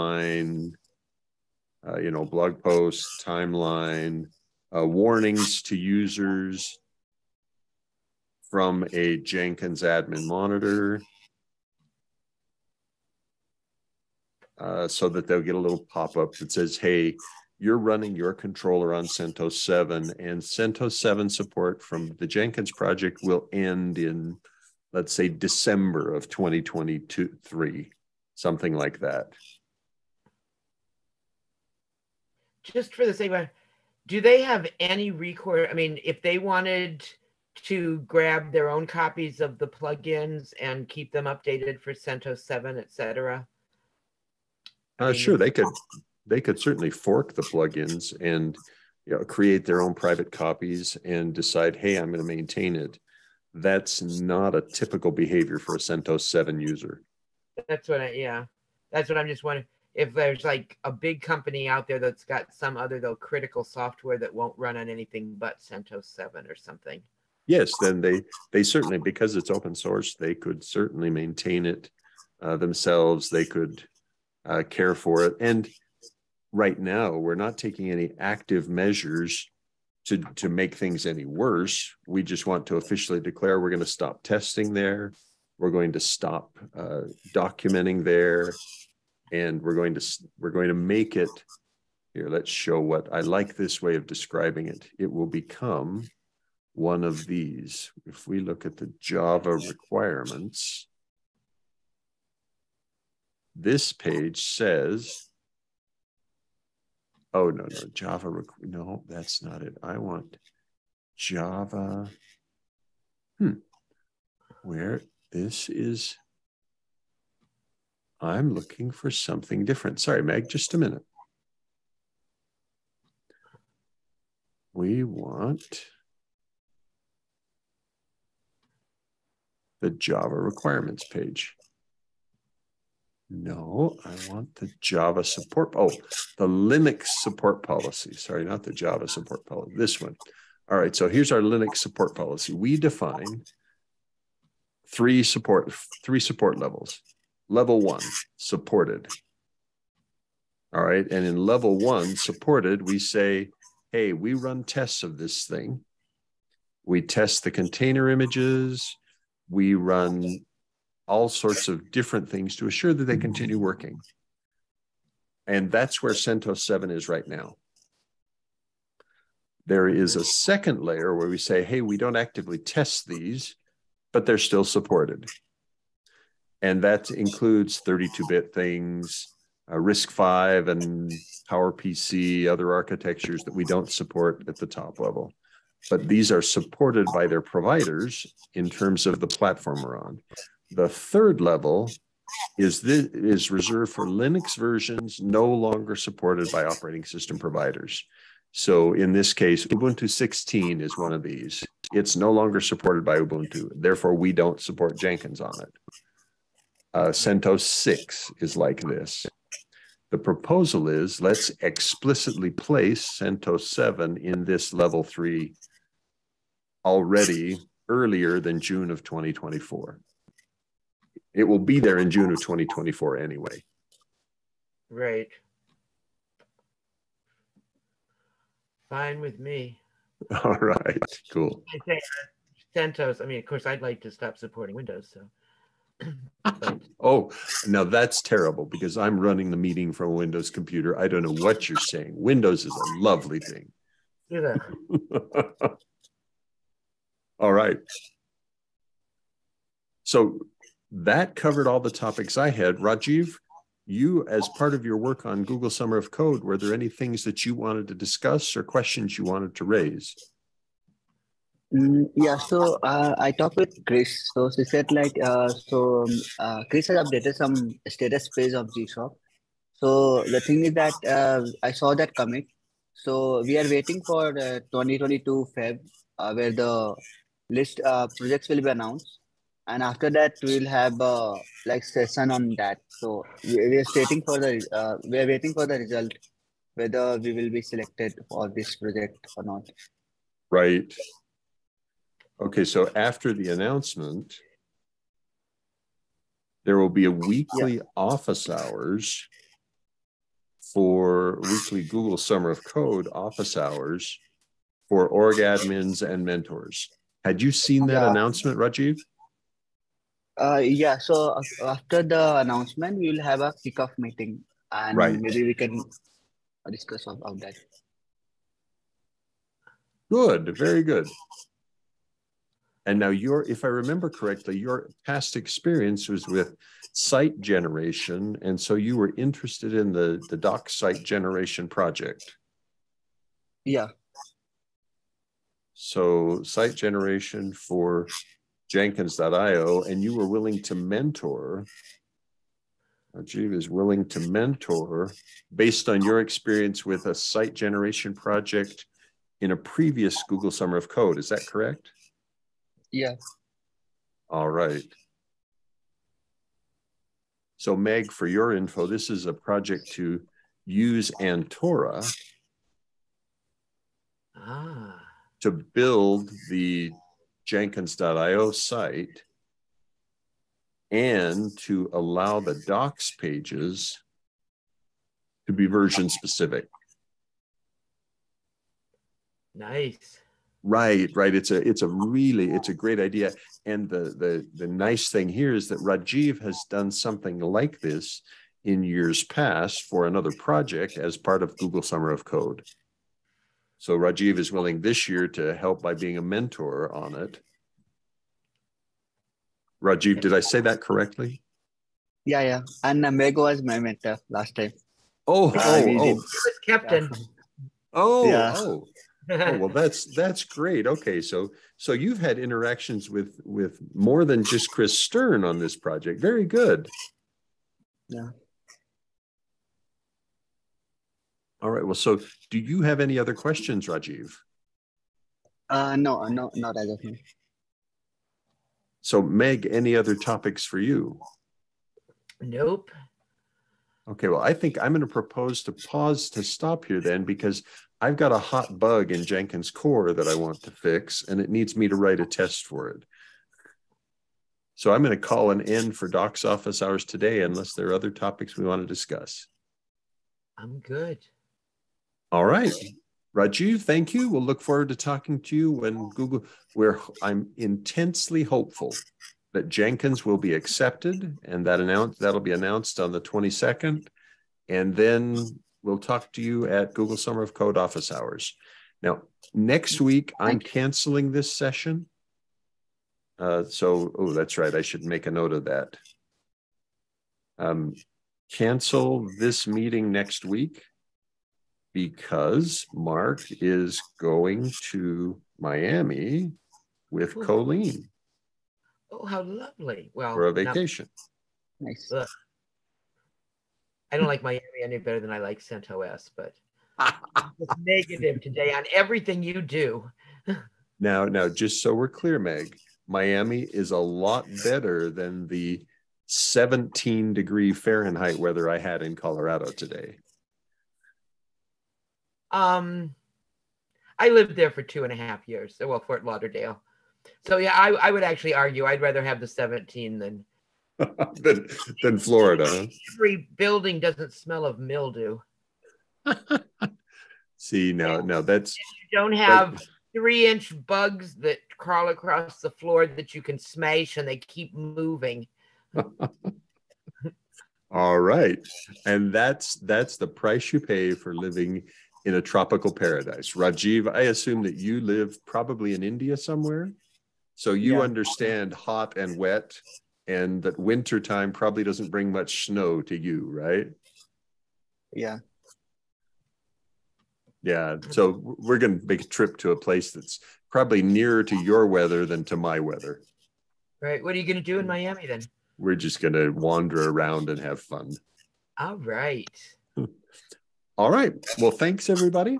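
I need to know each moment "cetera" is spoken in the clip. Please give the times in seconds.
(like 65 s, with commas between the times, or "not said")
42 s.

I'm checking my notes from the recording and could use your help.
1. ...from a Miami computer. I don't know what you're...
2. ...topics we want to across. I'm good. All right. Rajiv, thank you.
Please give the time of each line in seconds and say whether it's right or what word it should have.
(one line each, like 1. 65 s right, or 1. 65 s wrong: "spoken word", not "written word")
1. 239 s wrong: "Windows", not "Miami"
2. 448 s wrong: "discuss", not "across".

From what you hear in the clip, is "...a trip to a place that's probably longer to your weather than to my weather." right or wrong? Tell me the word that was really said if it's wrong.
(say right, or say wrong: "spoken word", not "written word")
wrong: "nearer", not "longer".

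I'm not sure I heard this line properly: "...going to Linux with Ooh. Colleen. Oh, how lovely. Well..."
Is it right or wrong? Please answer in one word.
wrong.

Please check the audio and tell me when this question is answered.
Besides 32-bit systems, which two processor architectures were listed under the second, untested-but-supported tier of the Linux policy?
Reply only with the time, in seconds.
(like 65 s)
179 s.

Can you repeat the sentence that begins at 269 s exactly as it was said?
So the thing is that uh, I saw that comic.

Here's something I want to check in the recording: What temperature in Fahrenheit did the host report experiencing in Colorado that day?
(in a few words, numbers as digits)
17 degrees.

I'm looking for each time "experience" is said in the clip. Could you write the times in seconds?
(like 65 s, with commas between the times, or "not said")
325 s, 346 s.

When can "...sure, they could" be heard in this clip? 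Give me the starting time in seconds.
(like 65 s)
45 s.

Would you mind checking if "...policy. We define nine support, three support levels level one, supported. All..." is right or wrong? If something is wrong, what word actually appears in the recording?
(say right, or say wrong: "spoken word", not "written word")
wrong: "three", not "nine".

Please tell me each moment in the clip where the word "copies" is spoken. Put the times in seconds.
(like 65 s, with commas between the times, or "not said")
38 s, 50 s.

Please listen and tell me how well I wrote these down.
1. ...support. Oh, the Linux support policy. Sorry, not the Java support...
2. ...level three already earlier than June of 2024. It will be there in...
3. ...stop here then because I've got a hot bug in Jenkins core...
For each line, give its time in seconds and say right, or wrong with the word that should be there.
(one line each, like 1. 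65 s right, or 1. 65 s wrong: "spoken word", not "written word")
1. 135 s right
2. 214 s right
3. 436 s right.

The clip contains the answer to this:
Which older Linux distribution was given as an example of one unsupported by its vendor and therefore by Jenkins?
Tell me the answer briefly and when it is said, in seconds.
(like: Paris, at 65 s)
Ubuntu 16, at 199 s.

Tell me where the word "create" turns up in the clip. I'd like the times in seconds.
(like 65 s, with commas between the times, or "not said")
49 s.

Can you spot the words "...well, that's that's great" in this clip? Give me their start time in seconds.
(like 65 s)
409 s.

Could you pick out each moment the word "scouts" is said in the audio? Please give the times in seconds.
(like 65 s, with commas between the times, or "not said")
not said.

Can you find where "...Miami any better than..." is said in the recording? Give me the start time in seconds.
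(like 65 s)
494 s.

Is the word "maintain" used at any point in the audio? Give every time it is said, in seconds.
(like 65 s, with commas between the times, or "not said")
52 s, 71 s.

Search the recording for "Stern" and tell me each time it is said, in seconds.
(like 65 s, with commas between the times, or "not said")
414 s.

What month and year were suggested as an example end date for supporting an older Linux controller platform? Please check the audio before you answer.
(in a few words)
December 2023.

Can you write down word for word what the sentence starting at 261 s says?
Mm, yeah, so uh, I talked with Chris.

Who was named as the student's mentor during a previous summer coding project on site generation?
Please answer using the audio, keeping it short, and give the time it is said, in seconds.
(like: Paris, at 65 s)
Amego, at 403 s.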